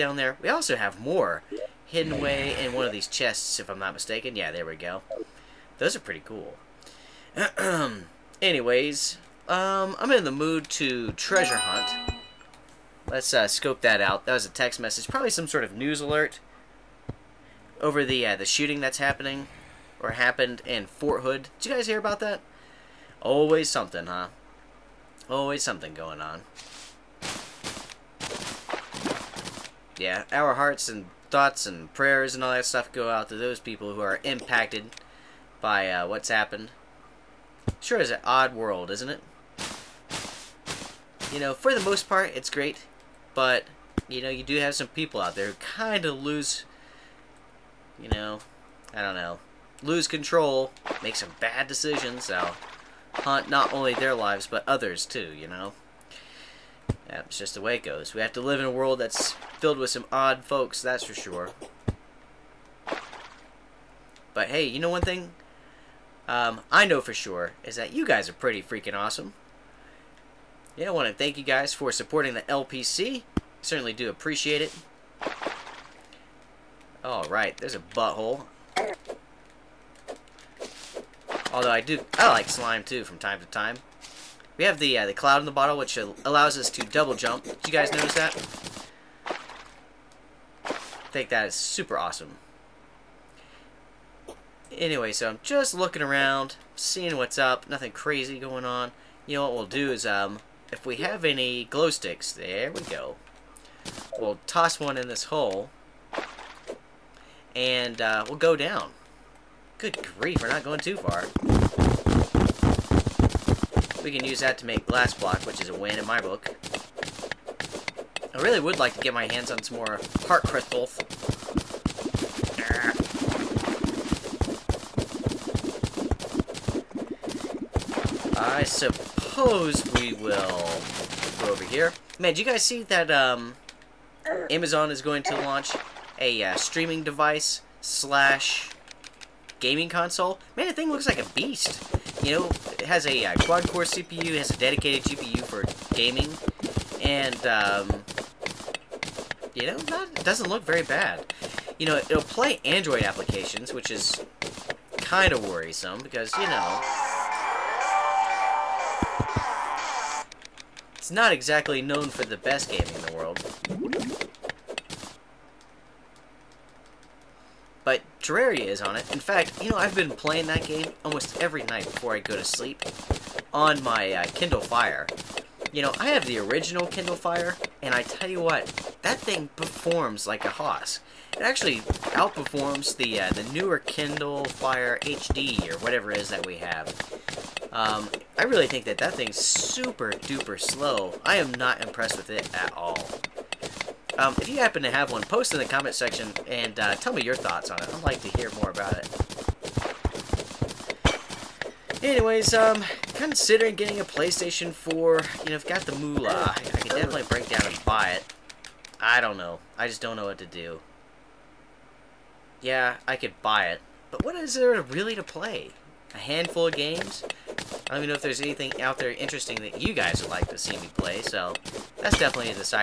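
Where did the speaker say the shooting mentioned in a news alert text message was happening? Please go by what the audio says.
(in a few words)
Fort Hood.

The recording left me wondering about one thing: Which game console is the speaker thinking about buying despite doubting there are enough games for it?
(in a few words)
PlayStation 4.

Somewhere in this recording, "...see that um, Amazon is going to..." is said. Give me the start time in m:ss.
2:12.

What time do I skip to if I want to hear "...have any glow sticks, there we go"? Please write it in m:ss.
1:40.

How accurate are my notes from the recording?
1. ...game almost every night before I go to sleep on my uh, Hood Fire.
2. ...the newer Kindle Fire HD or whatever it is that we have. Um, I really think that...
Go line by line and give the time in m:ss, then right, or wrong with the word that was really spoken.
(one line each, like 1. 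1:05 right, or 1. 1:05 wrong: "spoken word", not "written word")
1. 2:50 wrong: "Kindle", not "Hood"
2. 3:03 right.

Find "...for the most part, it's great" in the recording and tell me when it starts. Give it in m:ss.
0:41.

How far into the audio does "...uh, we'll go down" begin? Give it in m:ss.
1:47.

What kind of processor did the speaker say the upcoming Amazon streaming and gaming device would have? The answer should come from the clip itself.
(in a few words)
quad-core CPU.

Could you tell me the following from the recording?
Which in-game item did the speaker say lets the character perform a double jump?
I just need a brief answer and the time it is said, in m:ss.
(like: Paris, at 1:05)
cloud in the bottle, at 1:25.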